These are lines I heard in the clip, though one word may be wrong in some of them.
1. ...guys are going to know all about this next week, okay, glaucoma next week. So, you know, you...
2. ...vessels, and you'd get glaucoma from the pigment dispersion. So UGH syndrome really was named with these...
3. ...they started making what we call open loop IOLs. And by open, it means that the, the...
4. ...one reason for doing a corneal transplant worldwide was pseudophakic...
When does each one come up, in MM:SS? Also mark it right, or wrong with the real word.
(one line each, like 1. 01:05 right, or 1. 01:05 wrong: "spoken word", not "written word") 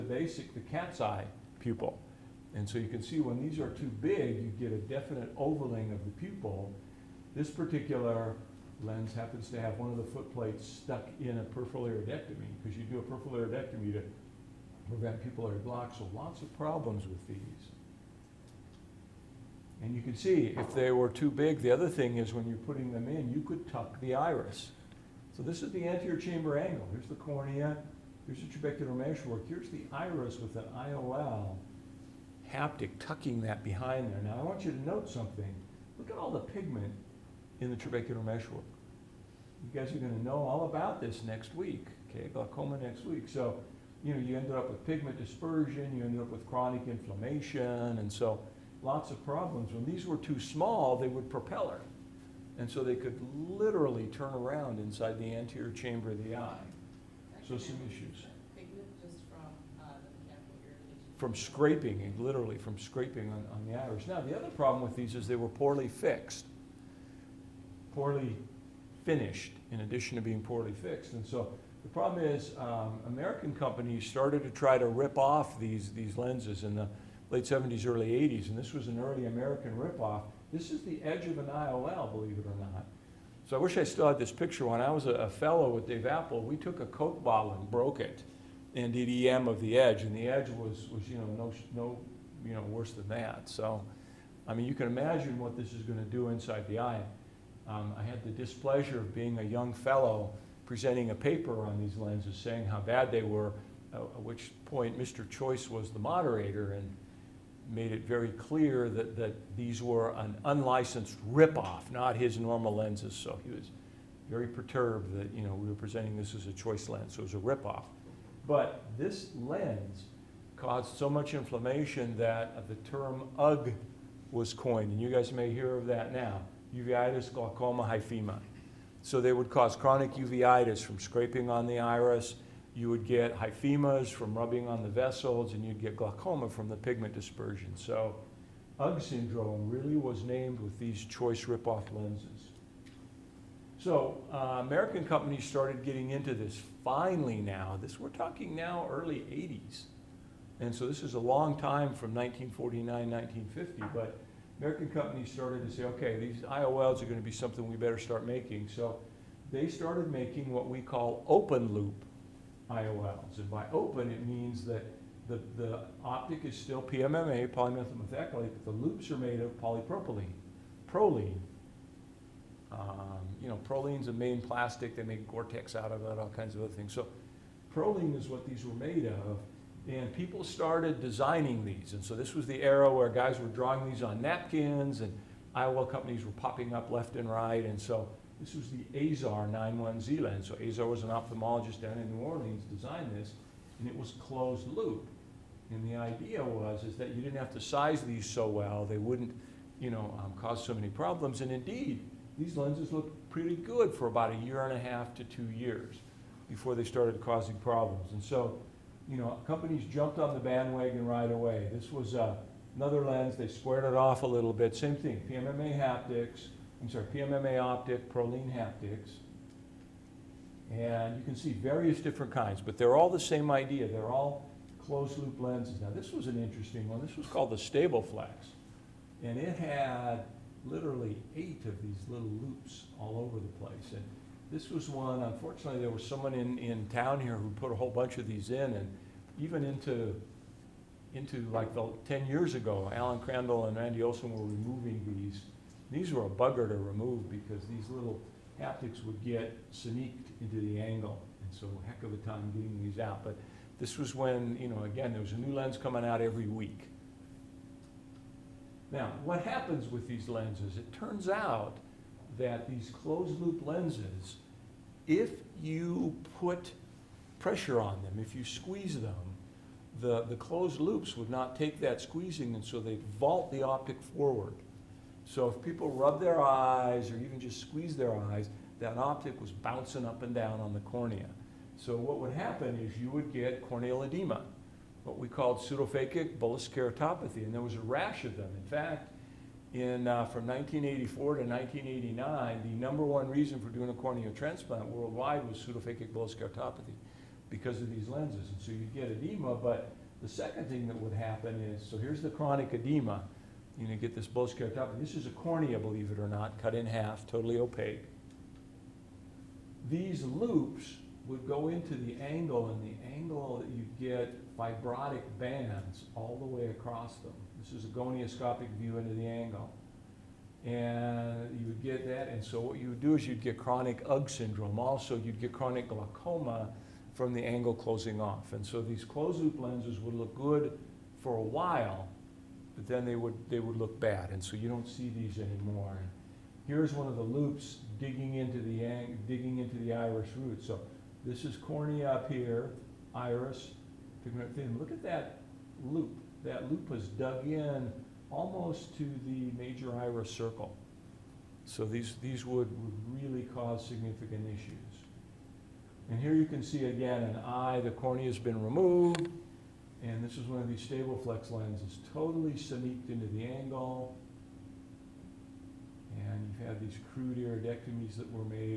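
1. 00:39 right
2. 02:14 right
3. 02:39 right
4. 04:53 right.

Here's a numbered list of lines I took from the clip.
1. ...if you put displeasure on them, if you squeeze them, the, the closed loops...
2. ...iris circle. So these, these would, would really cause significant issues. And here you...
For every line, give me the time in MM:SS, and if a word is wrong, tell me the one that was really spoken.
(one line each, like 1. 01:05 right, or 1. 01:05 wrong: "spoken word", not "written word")
1. 04:25 wrong: "pressure", not "displeasure"
2. 05:49 right.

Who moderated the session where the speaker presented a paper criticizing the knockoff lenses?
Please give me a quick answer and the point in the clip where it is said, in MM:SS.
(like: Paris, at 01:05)
Mr. Choyce, at 01:44.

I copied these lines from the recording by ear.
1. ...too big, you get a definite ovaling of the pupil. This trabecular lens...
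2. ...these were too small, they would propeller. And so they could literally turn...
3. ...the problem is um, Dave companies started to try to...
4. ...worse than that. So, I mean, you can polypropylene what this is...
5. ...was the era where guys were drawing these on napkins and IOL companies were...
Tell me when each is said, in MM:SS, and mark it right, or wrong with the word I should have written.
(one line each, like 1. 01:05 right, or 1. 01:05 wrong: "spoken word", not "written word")
1. 00:03 wrong: "particular", not "trabecular"
2. 00:49 right
3. 01:11 wrong: "American", not "Dave"
4. 01:32 wrong: "imagine", not "polypropylene"
5. 03:02 right.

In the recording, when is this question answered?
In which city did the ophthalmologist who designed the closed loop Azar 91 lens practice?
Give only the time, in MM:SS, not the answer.
03:12.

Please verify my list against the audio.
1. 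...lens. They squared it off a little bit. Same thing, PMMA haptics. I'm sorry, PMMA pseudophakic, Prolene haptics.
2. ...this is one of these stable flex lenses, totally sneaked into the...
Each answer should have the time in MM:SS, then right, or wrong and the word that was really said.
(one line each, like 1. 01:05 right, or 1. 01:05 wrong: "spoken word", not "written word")
1. 03:33 wrong: "optic", not "pseudophakic"
2. 06:00 right.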